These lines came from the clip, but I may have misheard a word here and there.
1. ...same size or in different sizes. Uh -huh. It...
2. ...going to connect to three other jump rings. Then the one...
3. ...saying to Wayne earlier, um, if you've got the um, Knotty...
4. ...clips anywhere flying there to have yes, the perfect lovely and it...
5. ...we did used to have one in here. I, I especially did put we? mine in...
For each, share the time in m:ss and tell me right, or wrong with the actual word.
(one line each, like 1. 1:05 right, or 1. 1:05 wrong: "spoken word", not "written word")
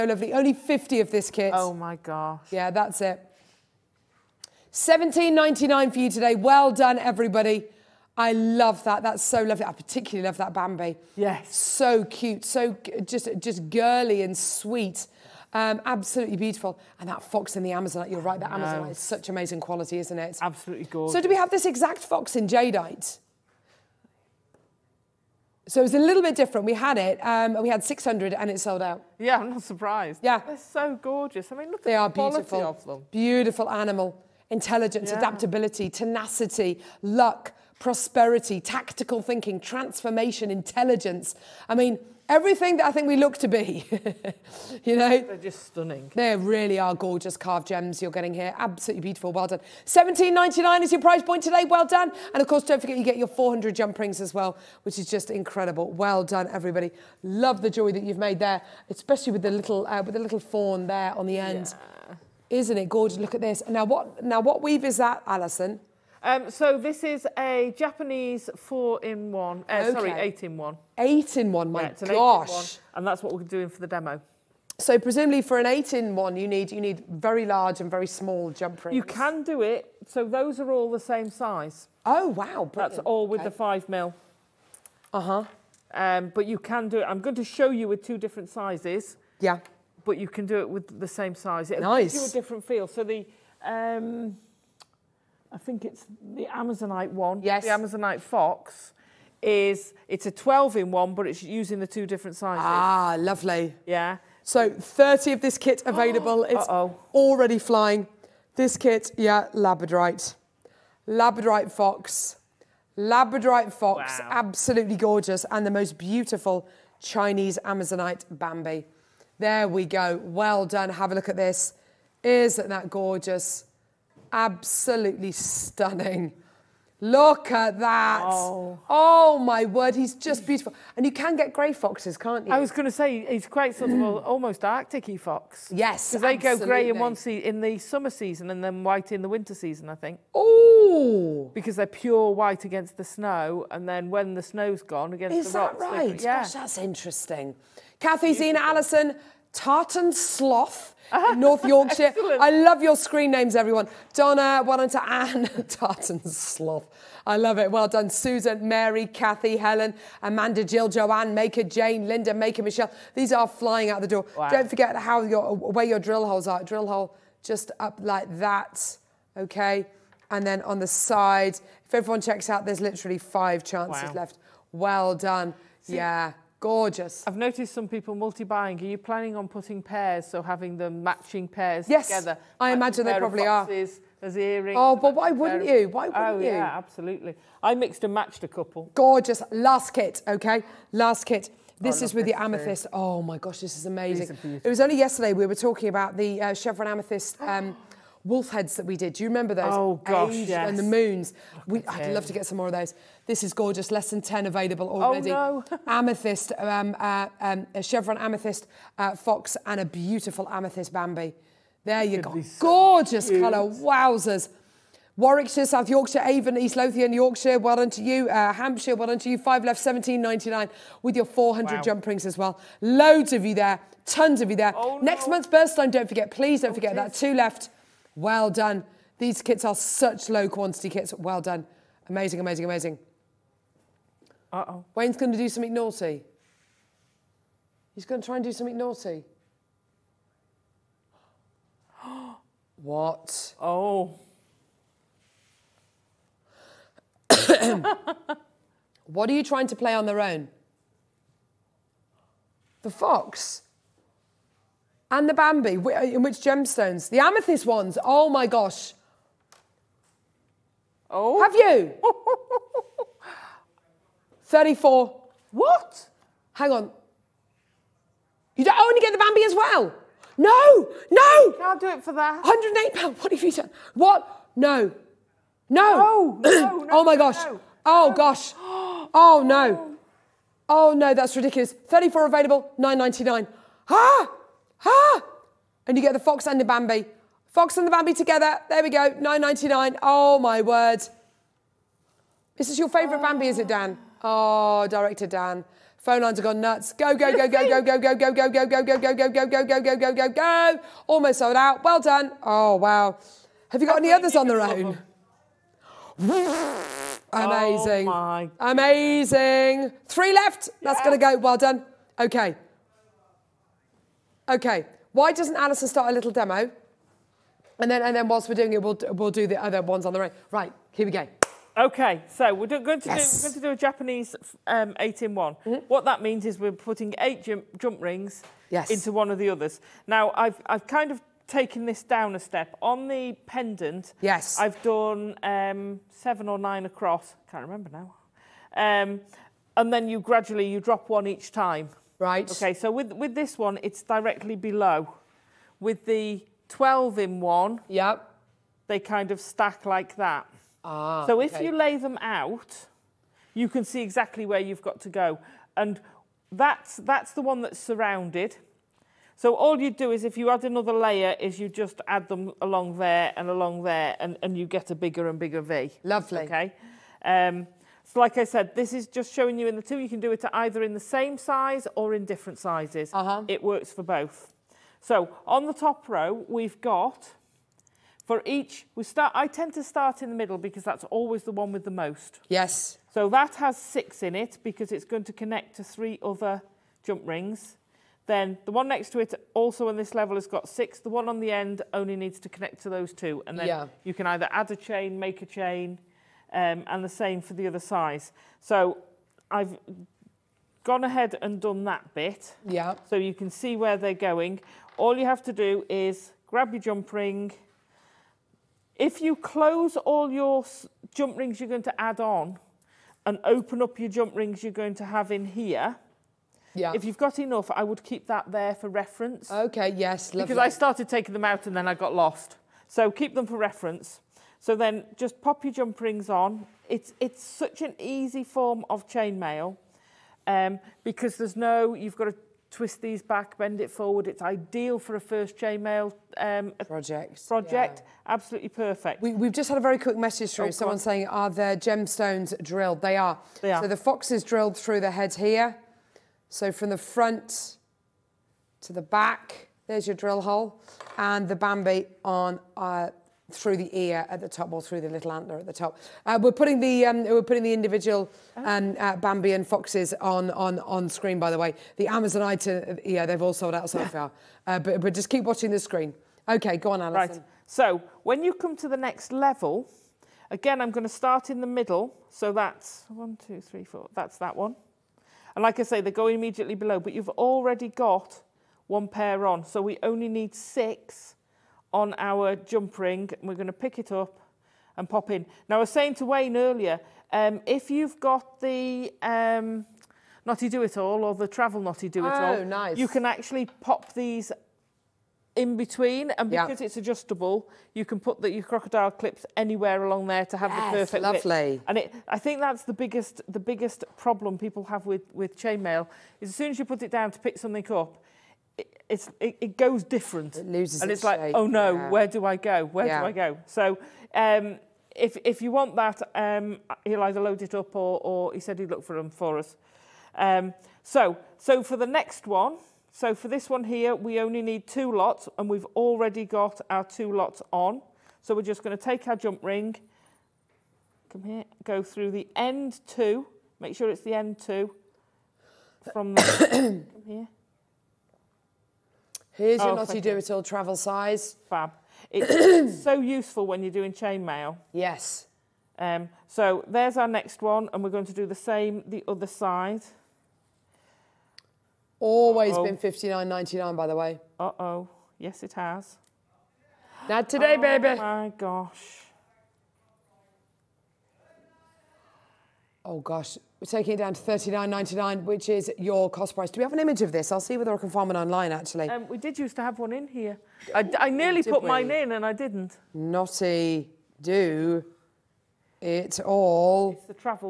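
1. 6:10 right
2. 6:25 right
3. 8:05 right
4. 8:19 wrong: "along", not "flying"
5. 9:29 wrong: "nearly", not "especially".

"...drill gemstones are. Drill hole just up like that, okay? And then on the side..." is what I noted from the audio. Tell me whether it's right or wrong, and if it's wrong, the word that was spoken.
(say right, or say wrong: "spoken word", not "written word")
wrong: "holes", not "gemstones".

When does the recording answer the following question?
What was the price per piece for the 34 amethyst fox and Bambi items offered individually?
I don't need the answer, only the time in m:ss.
4:42.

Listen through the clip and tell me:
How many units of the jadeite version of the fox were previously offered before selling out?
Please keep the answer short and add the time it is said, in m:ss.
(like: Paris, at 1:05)
600, at 0:27.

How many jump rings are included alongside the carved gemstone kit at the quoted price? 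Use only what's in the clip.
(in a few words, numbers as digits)
400.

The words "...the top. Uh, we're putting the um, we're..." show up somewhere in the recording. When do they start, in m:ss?
7:35.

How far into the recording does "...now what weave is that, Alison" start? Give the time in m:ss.
1:04.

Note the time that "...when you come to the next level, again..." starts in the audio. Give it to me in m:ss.
7:48.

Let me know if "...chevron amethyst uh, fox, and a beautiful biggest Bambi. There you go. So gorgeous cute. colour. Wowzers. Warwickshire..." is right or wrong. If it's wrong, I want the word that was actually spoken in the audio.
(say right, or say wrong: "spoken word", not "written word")
wrong: "amethyst", not "biggest".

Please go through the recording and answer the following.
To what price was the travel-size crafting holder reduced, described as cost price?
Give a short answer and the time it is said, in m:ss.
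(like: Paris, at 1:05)
39.99, at 9:24.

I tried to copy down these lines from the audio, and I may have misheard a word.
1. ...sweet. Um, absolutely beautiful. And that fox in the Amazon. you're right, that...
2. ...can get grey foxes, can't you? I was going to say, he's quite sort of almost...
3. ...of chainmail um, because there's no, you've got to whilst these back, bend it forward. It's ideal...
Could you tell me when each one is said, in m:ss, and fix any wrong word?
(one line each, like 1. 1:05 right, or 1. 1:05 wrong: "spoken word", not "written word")
1. 0:14 right
2. 2:11 right
3. 7:08 wrong: "twist", not "whilst".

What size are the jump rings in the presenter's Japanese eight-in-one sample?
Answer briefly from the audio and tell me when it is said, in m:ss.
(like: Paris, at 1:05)
5 mil, at 1:23.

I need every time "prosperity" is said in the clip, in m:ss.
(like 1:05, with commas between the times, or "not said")
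0:37.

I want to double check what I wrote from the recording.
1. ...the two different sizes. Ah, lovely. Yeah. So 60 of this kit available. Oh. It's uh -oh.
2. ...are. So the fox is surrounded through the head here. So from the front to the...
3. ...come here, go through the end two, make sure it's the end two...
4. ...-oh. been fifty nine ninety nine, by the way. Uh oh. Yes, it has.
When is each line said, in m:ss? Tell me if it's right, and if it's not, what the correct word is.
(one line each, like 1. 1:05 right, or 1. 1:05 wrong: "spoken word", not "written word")
1. 1:41 wrong: "30", not "60"
2. 7:23 wrong: "drilled", not "surrounded"
3. 8:51 right
4. 9:12 right.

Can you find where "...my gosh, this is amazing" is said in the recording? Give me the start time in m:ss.
3:13.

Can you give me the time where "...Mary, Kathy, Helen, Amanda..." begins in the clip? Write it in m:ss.
2:38.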